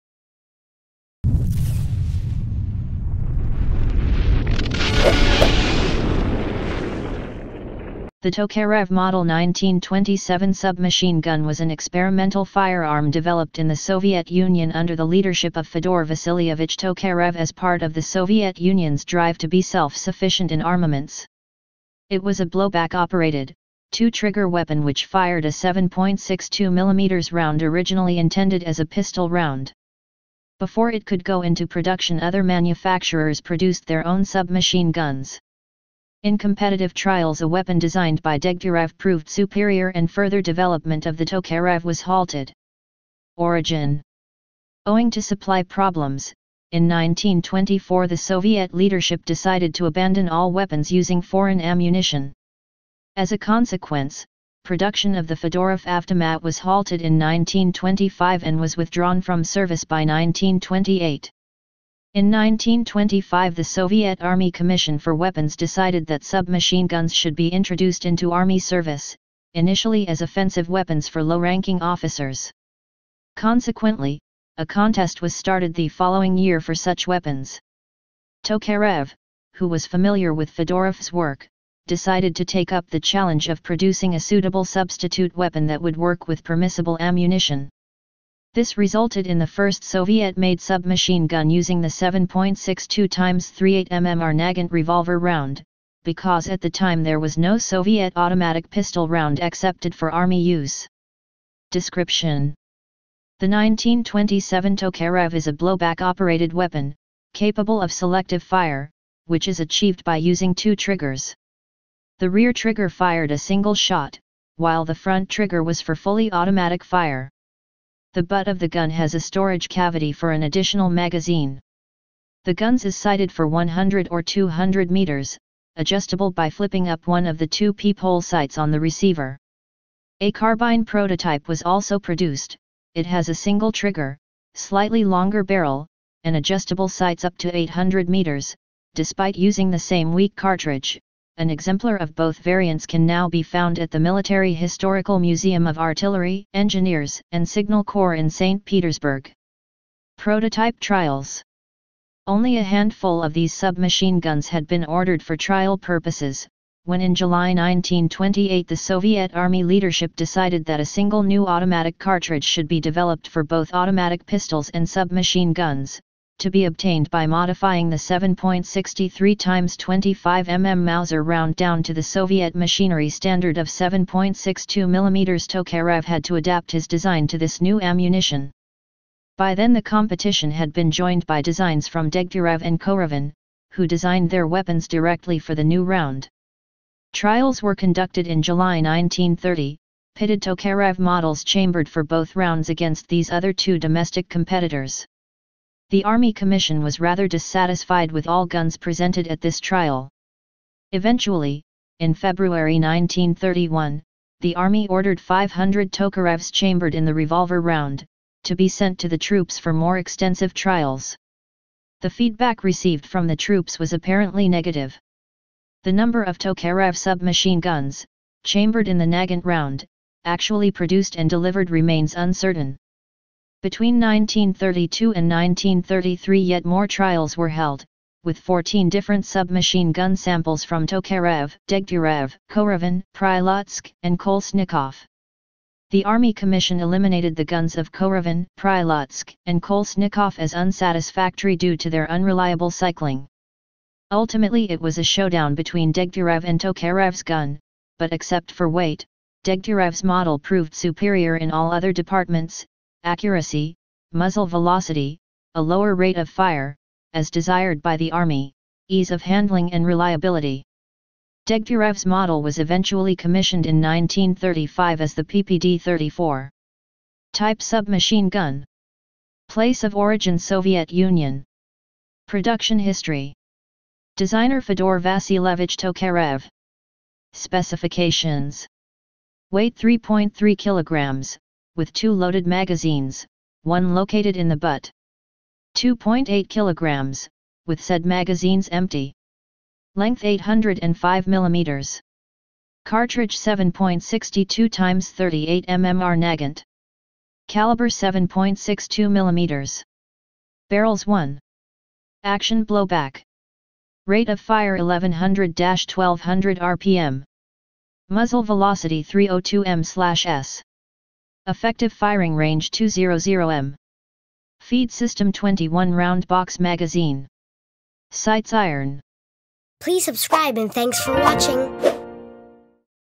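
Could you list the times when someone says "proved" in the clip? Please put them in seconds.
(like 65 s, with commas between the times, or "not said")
38 s, 250 s.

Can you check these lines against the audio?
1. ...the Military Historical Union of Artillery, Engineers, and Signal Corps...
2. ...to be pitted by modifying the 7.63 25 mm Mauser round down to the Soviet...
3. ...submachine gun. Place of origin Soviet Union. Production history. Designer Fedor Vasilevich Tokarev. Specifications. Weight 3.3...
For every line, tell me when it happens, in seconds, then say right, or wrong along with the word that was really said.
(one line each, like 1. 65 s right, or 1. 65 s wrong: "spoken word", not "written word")
1. 143 s wrong: "Museum", not "Union"
2. 166 s wrong: "obtained", not "pitted"
3. 267 s right.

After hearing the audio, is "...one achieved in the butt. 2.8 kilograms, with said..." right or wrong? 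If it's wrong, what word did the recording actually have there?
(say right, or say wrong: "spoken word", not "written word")
wrong: "located", not "achieved".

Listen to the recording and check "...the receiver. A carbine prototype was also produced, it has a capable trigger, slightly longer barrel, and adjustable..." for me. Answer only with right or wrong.
wrong.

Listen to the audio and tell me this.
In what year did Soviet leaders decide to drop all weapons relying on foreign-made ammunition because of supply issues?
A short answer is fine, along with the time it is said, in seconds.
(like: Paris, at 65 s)
1924, at 46 s.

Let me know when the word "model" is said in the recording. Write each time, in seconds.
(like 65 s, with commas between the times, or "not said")
8 s, 190 s, 250 s, 262 s.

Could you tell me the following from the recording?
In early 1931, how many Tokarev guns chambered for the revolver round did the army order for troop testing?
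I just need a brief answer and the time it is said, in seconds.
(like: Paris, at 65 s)
500, at 205 s.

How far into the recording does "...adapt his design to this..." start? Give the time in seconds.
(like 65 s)
176 s.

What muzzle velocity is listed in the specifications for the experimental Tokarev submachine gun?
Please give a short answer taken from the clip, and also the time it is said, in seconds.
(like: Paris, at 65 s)
302 m/s, at 309 s.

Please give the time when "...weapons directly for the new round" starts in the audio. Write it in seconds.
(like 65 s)
184 s.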